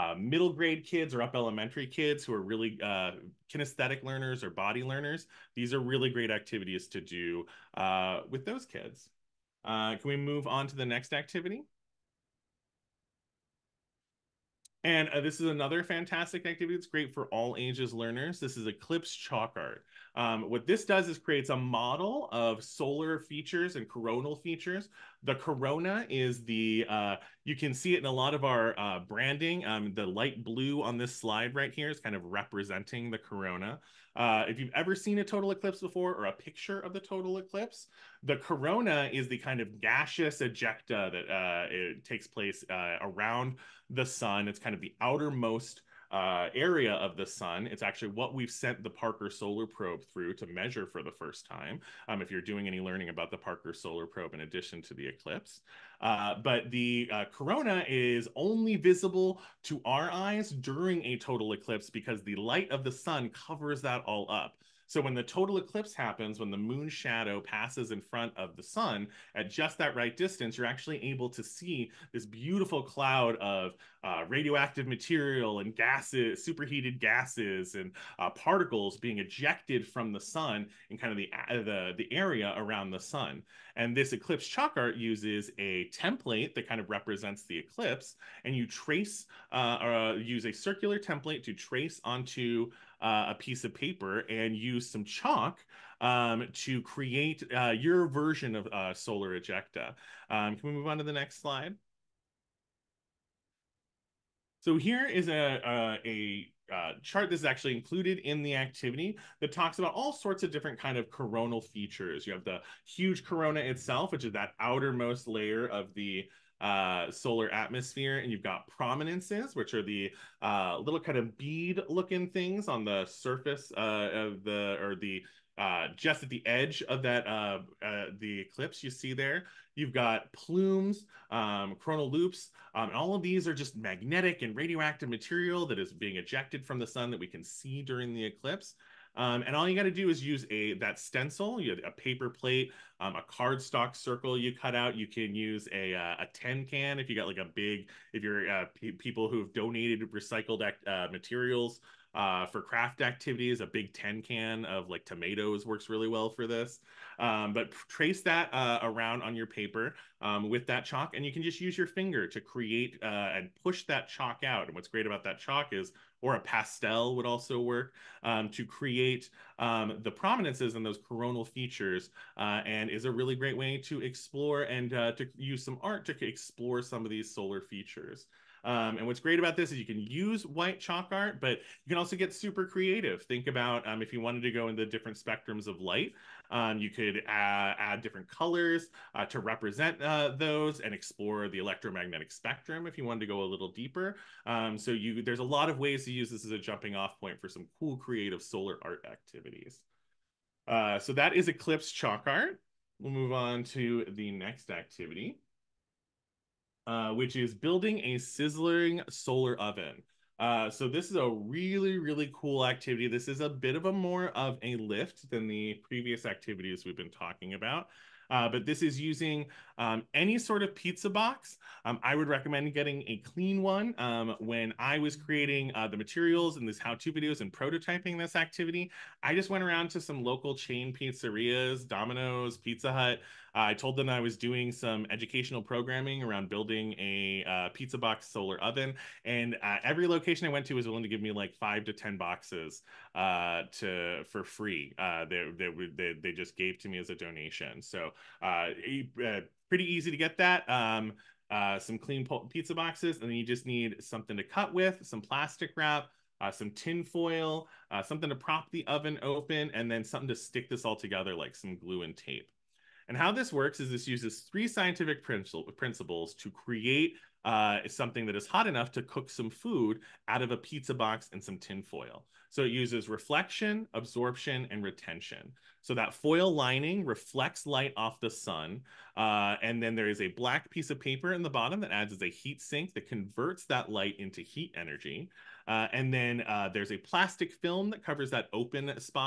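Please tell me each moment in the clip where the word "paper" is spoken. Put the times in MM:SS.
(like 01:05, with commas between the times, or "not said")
01:33, 02:21, 02:39, 04:41.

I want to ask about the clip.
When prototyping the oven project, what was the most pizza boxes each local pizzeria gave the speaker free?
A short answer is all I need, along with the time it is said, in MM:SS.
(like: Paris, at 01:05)
10, at 04:01.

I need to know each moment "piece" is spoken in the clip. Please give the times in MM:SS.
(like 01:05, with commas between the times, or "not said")
01:33, 04:40.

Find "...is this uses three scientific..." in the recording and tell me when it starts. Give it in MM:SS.
04:23.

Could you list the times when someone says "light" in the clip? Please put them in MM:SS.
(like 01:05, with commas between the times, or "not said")
00:30, 01:02, 03:05, 04:37, 04:43.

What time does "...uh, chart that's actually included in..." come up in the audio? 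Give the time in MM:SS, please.
01:46.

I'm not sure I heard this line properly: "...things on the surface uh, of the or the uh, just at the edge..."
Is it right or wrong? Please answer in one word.
right.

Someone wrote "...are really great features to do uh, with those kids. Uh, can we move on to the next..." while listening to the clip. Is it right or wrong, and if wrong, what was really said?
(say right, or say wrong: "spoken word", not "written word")
wrong: "activities", not "features".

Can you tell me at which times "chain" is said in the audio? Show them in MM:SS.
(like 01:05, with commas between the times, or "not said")
03:50.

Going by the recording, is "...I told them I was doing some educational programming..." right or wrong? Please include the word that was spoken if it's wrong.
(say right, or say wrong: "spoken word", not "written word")
right.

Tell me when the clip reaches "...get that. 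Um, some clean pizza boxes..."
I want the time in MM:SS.
04:10.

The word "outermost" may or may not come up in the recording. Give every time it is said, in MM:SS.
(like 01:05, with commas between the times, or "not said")
00:45, 01:54.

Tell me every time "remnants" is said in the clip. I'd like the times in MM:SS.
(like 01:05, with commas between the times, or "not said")
not said.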